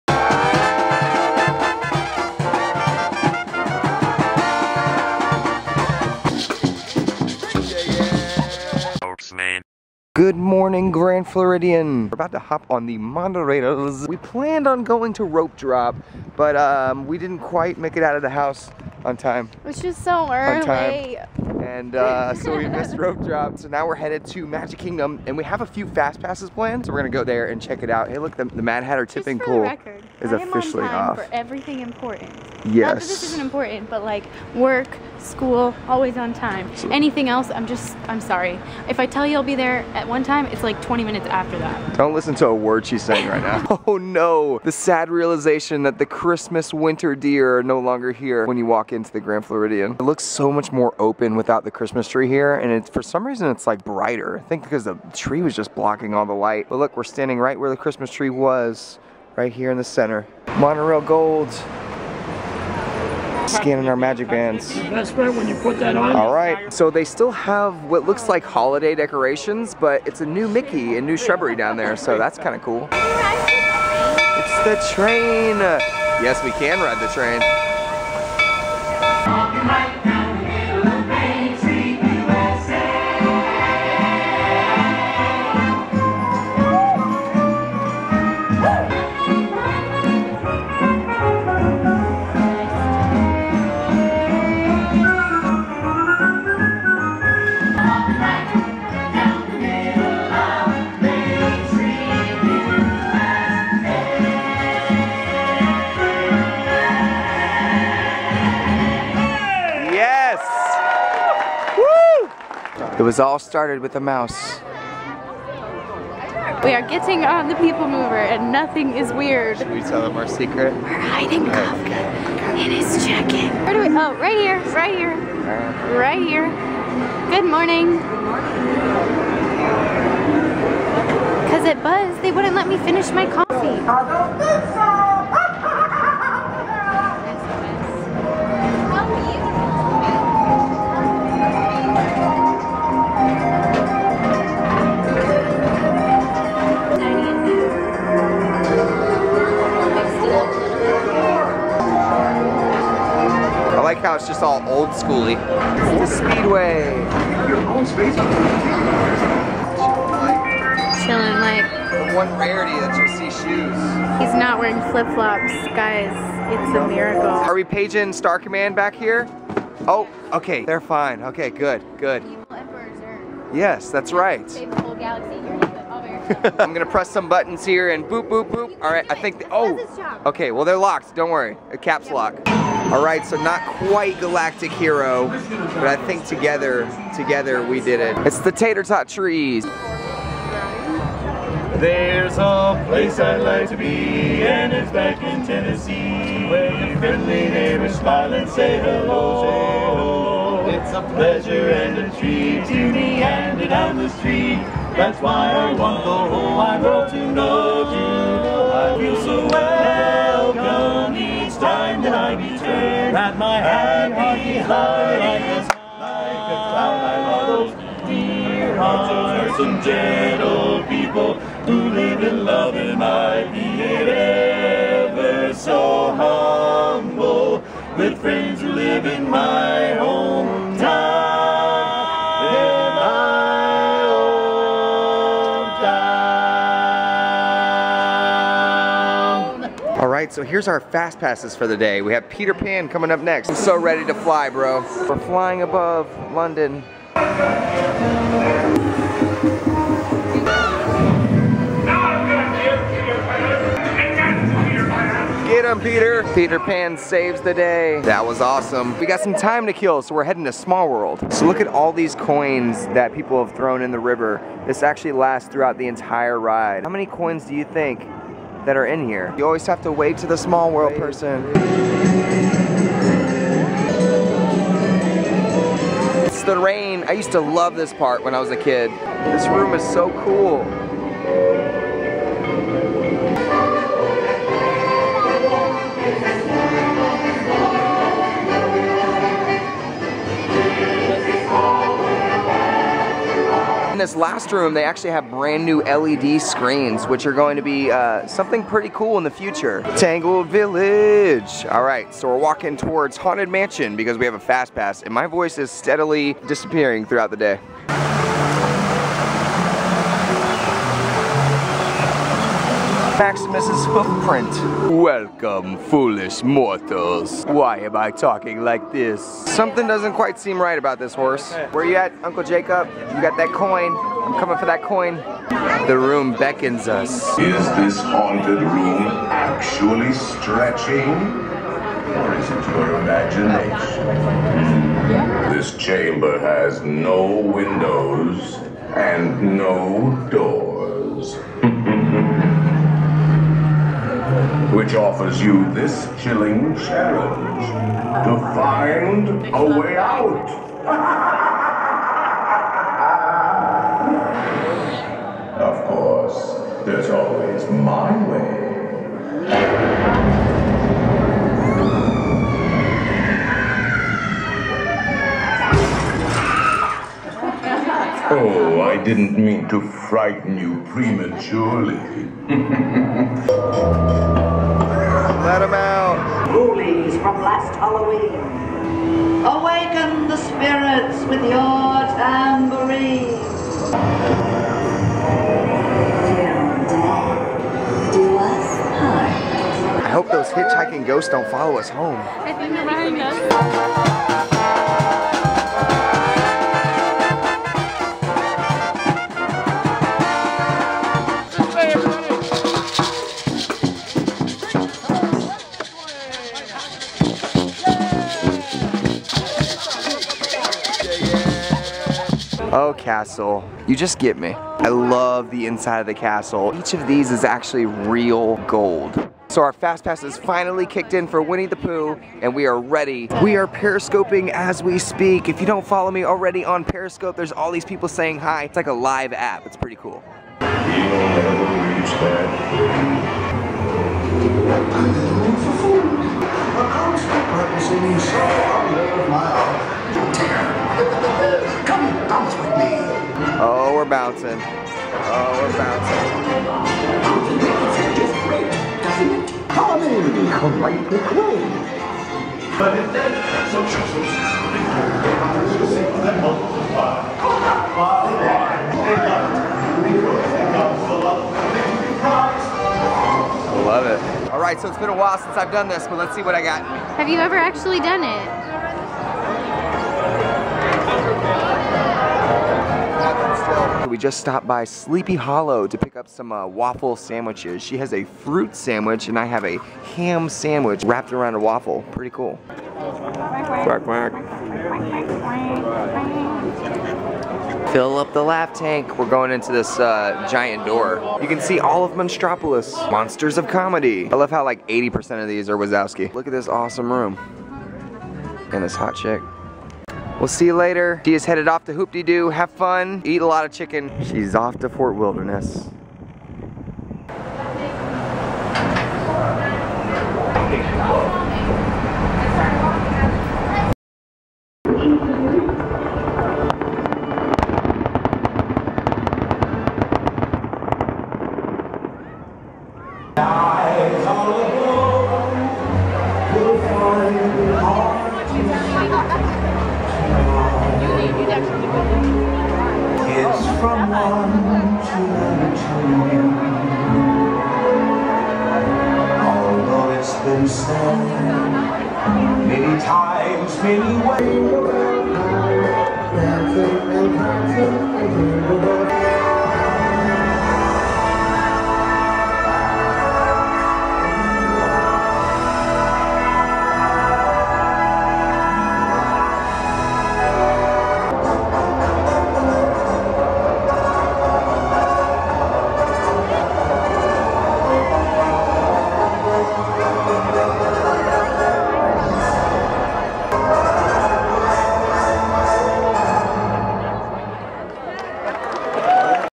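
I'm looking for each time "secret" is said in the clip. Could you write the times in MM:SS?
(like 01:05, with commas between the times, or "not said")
02:00.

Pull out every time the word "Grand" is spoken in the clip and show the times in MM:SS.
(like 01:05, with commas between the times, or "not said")
00:10, 00:49.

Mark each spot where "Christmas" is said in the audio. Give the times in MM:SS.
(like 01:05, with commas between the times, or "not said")
00:46, 00:51, 00:57.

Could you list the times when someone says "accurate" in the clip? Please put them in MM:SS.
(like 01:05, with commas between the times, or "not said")
not said.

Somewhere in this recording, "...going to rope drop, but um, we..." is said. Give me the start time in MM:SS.
00:14.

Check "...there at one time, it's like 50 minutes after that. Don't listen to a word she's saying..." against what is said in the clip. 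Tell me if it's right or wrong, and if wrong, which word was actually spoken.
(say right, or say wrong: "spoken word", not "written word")
wrong: "20", not "50".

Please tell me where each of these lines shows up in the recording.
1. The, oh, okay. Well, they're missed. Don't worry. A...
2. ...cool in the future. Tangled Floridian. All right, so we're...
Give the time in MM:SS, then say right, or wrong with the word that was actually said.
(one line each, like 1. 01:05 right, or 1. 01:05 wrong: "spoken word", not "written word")
1. 02:59 wrong: "locked", not "missed"
2. 04:58 wrong: "Village", not "Floridian".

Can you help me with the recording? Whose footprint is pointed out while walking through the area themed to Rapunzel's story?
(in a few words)
Maximus.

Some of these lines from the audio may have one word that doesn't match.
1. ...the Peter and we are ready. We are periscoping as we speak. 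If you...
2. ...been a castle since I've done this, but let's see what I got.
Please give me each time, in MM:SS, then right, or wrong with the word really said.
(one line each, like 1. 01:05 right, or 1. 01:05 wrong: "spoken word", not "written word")
1. 07:01 wrong: "Pooh", not "Peter"
2. 07:44 wrong: "while", not "castle".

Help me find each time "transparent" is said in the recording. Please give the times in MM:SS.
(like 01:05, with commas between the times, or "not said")
not said.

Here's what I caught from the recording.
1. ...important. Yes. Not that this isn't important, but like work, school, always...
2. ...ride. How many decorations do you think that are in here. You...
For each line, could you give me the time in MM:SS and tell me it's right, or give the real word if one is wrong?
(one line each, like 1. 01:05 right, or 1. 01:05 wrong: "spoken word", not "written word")
1. 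00:31 right
2. 04:26 wrong: "coins", not "decorations".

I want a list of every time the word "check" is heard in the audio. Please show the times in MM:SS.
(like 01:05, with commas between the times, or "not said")
00:27.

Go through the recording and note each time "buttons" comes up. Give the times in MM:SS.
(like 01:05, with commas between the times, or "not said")
02:57.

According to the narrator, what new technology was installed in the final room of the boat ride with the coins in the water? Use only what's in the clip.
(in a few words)
LED screens.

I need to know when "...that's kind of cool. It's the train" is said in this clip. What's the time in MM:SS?
01:12.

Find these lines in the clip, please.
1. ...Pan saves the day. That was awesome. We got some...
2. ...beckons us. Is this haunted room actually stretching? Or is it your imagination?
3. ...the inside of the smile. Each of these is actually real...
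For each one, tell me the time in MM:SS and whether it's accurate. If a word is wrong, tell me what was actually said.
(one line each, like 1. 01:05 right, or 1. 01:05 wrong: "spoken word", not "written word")
1. 04:16 right
2. 05:26 right
3. 06:55 wrong: "castle", not "smile".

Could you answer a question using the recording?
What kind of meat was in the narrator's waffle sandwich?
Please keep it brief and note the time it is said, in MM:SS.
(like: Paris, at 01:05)
Ham, at 08:00.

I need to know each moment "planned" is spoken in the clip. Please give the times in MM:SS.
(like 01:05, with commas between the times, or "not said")
00:14, 00:26.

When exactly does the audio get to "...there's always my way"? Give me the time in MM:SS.
05:56.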